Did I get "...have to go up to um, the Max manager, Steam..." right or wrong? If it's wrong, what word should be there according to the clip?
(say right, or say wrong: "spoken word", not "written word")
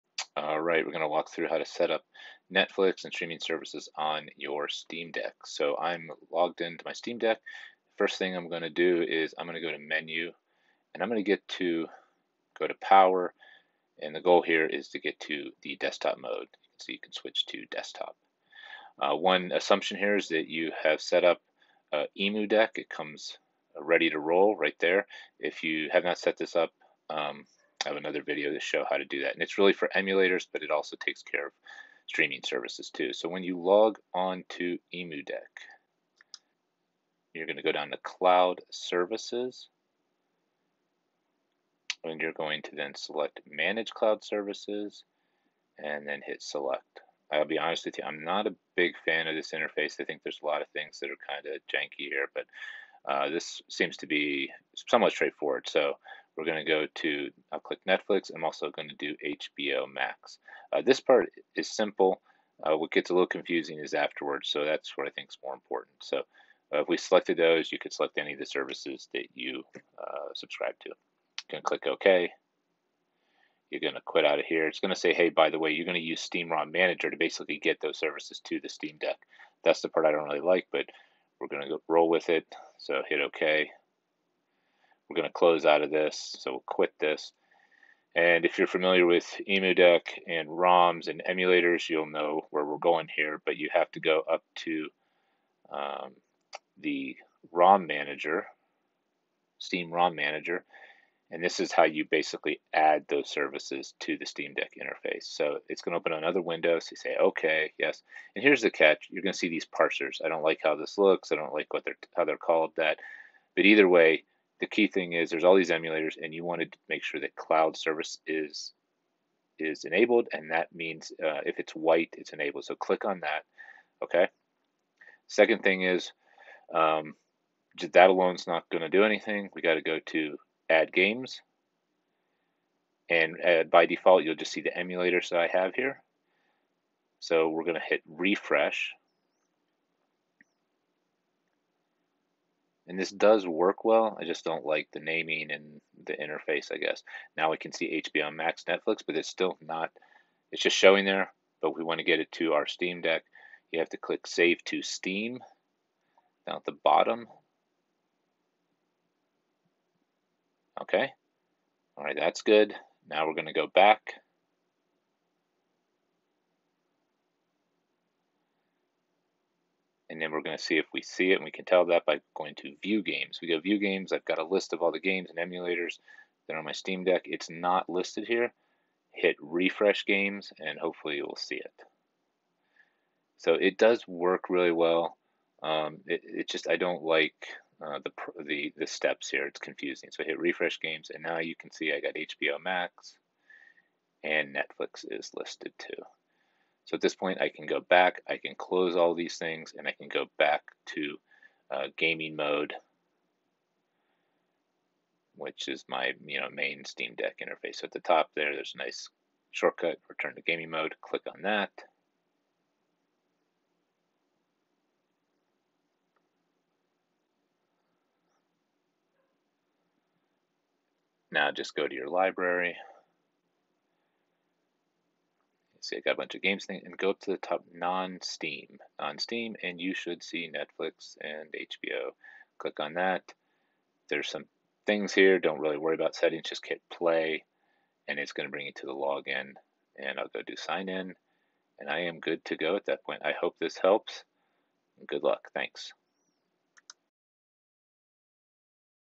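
wrong: "ROM", not "Max".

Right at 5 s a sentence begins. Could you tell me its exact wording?
So I'm logged into my Steam Deck.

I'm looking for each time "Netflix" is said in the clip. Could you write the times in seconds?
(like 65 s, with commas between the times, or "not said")
2 s, 57 s, 148 s, 194 s, 230 s.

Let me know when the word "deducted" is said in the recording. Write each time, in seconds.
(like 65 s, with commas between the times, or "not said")
not said.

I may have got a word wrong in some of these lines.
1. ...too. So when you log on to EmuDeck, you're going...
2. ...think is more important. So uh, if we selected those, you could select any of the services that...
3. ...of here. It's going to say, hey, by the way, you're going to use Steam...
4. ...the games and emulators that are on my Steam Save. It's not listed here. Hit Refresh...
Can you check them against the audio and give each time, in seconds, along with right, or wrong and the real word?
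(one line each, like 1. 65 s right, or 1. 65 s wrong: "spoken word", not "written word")
1. 32 s right
2. 65 s right
3. 74 s right
4. 174 s wrong: "Deck", not "Save".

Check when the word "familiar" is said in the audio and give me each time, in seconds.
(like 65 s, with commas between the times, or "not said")
88 s.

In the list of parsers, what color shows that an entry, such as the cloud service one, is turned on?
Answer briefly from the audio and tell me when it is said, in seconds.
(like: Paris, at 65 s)
White, at 121 s.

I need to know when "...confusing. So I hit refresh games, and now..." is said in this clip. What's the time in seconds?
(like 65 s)
189 s.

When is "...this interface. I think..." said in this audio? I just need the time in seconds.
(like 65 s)
49 s.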